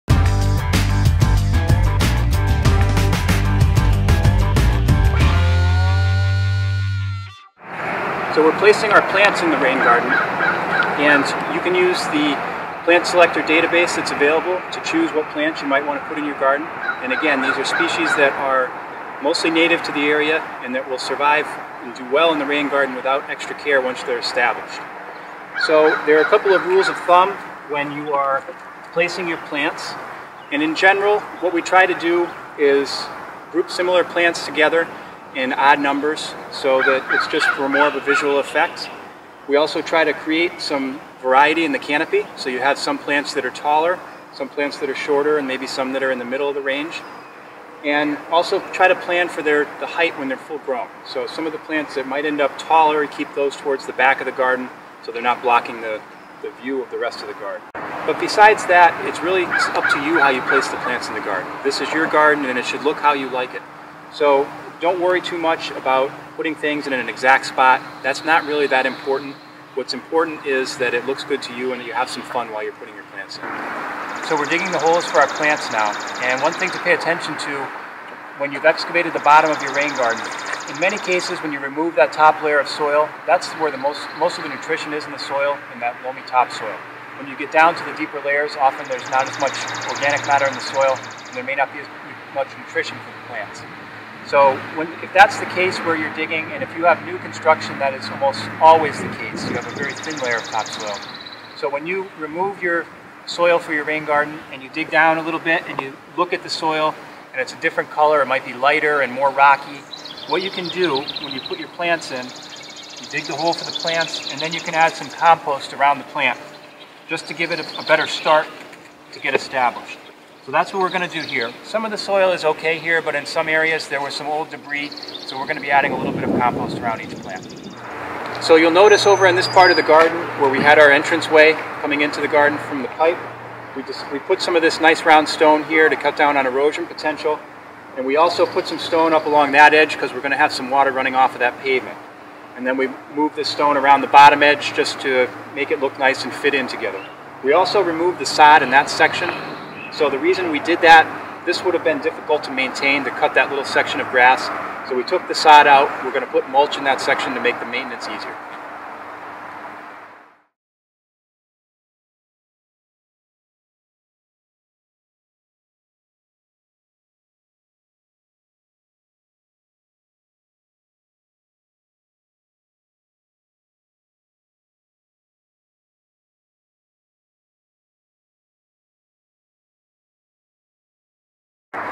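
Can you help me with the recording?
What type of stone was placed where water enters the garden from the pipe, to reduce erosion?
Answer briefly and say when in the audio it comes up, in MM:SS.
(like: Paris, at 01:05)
round stone, at 02:15.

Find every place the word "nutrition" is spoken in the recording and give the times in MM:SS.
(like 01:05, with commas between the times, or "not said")
01:24, 01:32.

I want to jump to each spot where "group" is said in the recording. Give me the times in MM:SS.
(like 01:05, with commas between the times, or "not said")
00:33.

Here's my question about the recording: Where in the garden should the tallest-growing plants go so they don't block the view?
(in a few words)
towards the back.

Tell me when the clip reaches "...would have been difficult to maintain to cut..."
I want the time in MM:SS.
02:31.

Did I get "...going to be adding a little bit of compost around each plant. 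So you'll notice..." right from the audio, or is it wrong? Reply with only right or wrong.
right.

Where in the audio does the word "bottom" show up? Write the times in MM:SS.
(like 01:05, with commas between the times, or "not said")
01:19, 02:24.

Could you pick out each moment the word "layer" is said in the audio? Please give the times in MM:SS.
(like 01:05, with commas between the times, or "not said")
01:22, 01:28, 01:40.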